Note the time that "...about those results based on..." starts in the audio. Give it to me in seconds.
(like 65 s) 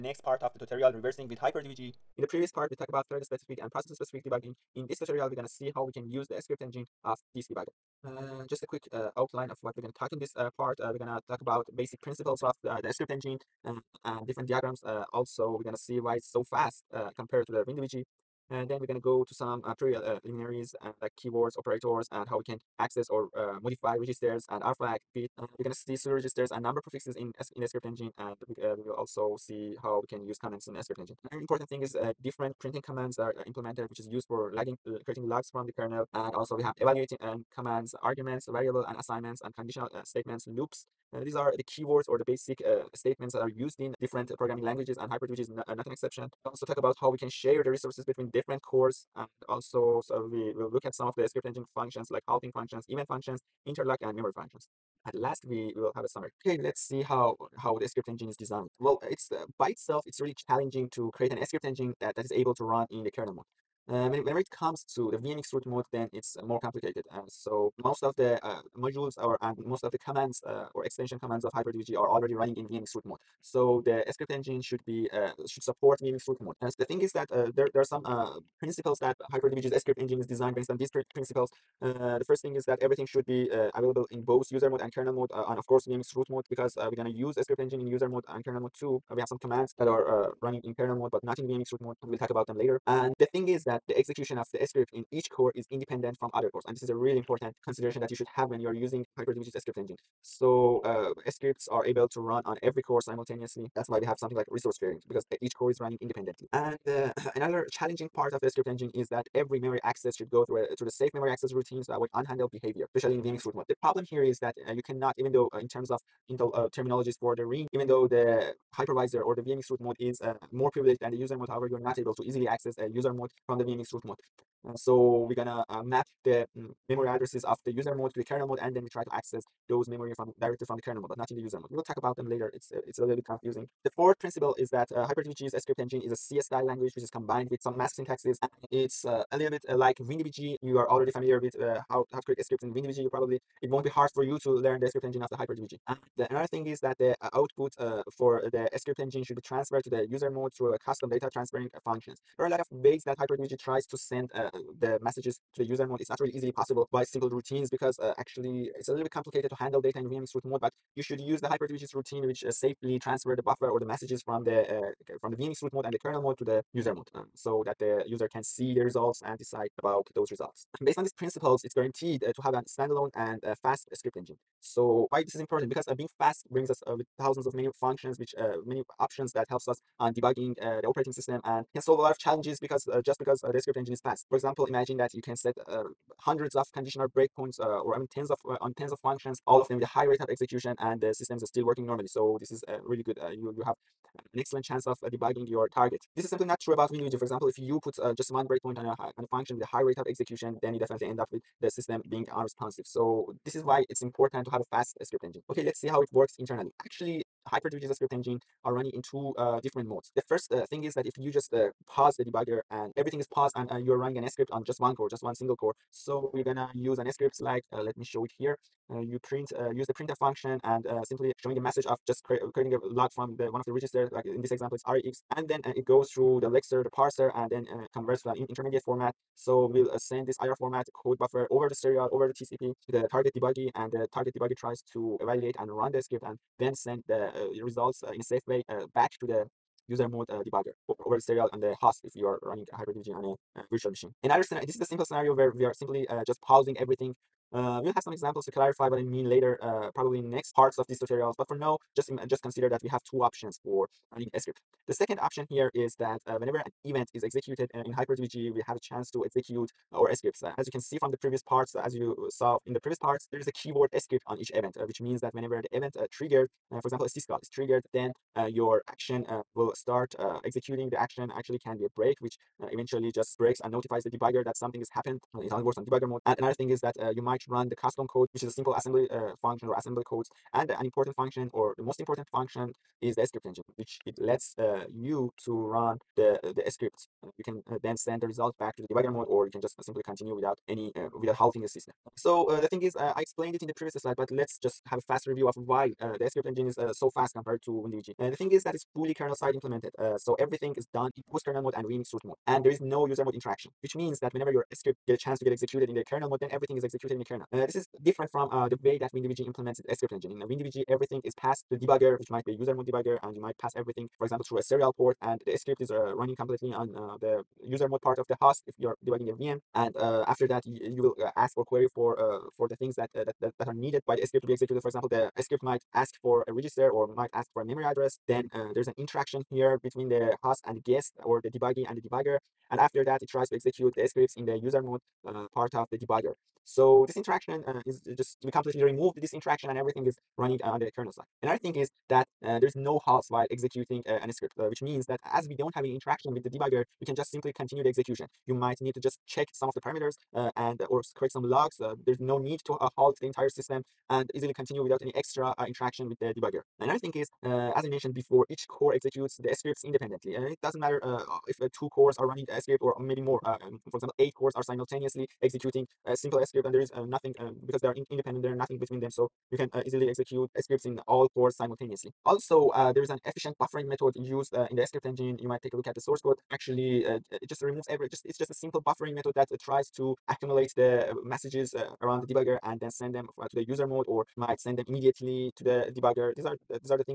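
169 s.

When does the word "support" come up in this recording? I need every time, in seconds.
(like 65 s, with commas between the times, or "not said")
75 s.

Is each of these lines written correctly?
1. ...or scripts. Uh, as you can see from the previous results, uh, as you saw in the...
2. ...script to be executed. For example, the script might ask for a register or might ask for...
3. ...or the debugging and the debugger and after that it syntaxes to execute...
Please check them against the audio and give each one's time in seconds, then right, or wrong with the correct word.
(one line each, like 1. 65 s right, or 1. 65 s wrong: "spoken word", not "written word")
1. 259 s wrong: "parts", not "results"
2. 324 s right
3. 331 s wrong: "tries", not "syntaxes".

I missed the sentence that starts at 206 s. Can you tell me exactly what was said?
Actually, HyperDBG is a script engine are running in two uh, different modes.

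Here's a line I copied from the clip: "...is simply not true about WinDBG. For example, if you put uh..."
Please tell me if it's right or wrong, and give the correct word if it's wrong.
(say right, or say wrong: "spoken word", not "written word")
right.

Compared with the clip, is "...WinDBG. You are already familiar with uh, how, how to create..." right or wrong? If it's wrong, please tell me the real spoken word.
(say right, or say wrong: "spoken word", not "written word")
right.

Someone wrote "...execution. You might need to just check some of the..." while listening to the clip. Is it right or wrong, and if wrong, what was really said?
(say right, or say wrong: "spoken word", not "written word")
right.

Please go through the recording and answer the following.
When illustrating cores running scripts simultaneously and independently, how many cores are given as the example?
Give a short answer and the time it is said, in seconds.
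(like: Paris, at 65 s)
8, at 364 s.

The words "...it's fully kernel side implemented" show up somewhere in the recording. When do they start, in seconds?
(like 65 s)
298 s.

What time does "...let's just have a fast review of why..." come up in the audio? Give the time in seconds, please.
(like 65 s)
294 s.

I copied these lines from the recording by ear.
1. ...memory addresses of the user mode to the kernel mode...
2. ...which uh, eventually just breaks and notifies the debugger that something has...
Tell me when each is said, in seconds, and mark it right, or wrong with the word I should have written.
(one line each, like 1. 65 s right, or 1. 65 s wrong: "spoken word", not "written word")
1. 126 s right
2. 272 s right.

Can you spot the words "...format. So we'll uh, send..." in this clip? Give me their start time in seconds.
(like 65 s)
228 s.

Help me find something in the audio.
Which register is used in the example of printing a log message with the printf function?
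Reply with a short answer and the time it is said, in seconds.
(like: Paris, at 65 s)
rex, at 224 s.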